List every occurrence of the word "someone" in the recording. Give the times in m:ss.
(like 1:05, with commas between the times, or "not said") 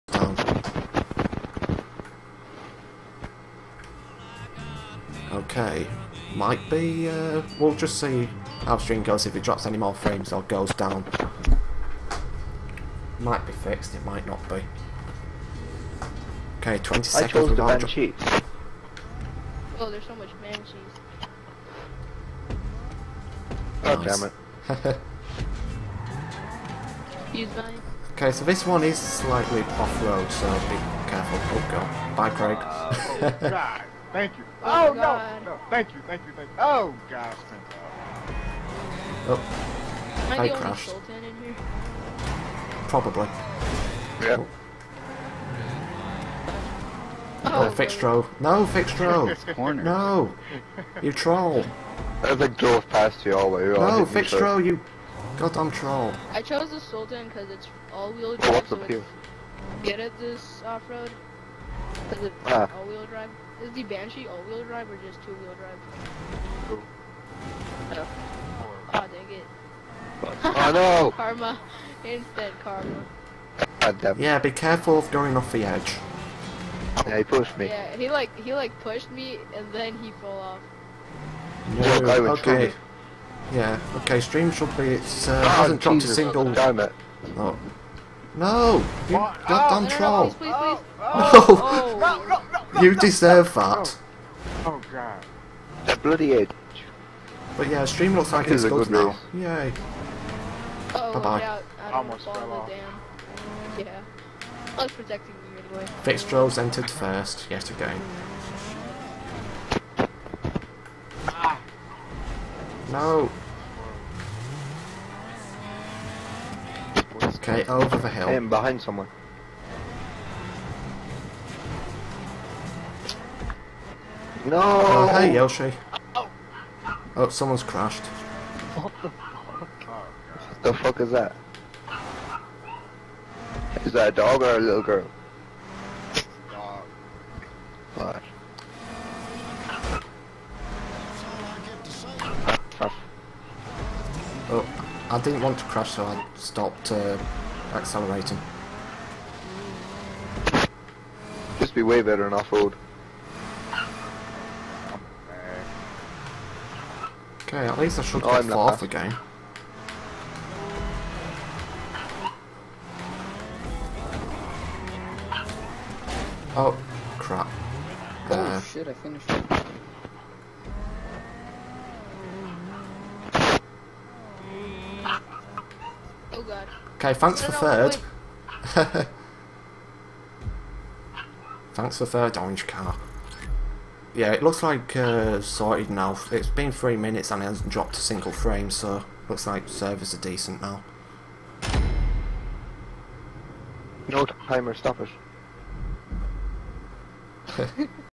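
1:58, 2:07.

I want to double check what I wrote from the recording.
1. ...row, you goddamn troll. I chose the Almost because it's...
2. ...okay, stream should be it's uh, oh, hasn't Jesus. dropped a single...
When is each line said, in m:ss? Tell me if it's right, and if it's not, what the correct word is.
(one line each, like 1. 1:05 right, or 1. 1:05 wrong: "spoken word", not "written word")
1. 0:54 wrong: "Sultan", not "Almost"
2. 1:23 right.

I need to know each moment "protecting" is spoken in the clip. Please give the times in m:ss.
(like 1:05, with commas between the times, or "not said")
1:44.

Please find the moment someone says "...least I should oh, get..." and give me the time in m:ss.
2:37.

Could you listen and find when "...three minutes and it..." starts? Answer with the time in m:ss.
3:06.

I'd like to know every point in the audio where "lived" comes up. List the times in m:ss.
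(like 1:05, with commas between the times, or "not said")
not said.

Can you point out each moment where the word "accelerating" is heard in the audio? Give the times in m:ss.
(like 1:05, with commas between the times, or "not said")
2:27.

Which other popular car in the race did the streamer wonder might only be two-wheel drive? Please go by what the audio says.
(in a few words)
Banshee.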